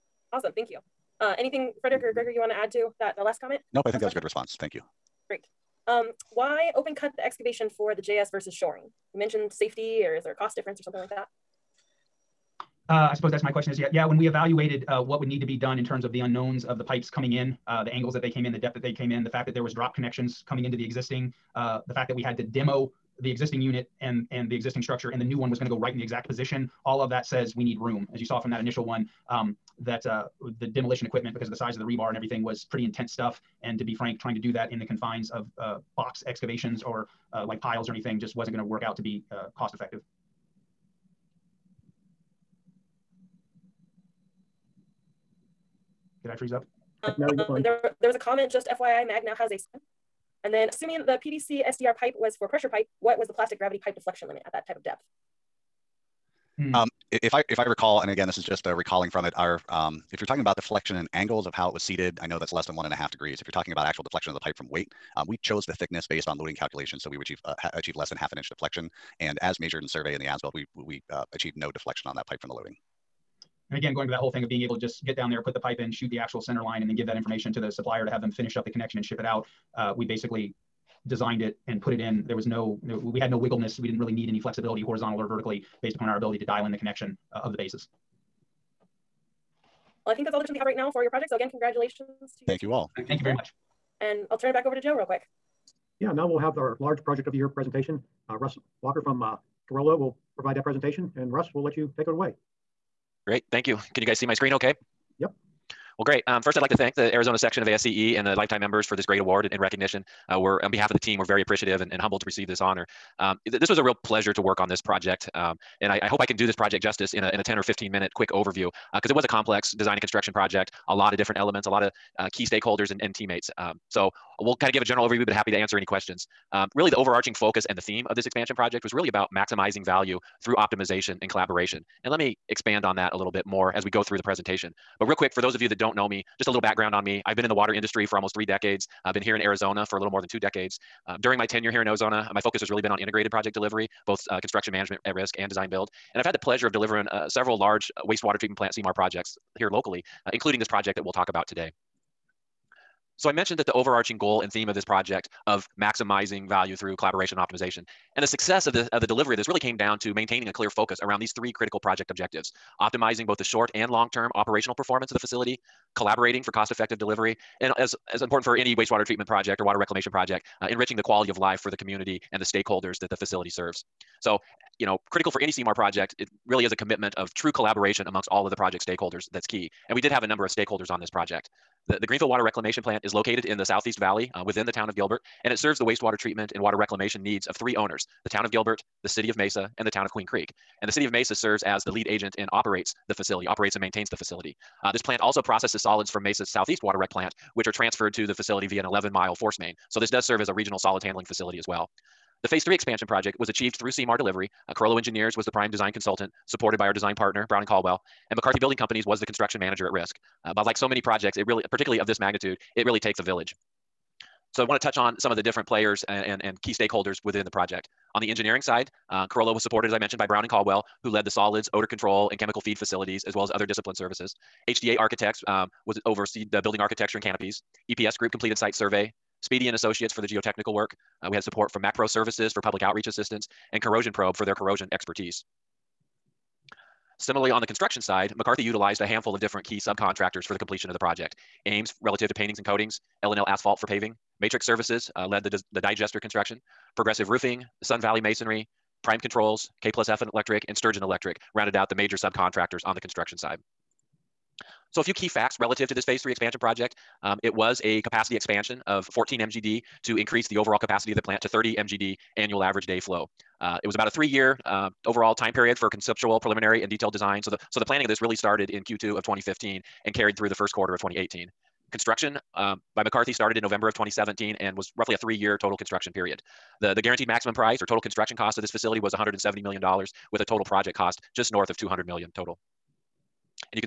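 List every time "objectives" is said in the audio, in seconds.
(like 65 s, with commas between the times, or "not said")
162 s.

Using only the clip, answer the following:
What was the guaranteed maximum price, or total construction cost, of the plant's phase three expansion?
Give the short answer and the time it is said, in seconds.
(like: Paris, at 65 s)
$170 million, at 279 s.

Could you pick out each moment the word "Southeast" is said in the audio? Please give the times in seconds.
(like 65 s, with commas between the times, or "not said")
183 s, 196 s.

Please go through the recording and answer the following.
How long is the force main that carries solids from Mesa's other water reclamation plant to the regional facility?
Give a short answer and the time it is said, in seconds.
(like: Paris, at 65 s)
11 miles, at 198 s.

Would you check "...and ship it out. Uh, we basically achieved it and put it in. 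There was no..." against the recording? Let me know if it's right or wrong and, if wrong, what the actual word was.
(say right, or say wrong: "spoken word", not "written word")
wrong: "designed", not "achieved".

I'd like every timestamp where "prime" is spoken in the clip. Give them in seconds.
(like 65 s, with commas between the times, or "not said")
205 s, 249 s.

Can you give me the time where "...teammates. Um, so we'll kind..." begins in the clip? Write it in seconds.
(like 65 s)
123 s.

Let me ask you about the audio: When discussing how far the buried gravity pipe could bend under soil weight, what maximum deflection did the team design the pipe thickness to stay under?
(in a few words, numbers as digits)
half an inch.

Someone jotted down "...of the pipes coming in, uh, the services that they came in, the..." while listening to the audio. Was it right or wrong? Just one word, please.
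wrong.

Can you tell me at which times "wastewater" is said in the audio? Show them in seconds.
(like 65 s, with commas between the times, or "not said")
148 s, 168 s, 185 s.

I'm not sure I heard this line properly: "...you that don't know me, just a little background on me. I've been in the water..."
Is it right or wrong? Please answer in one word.
right.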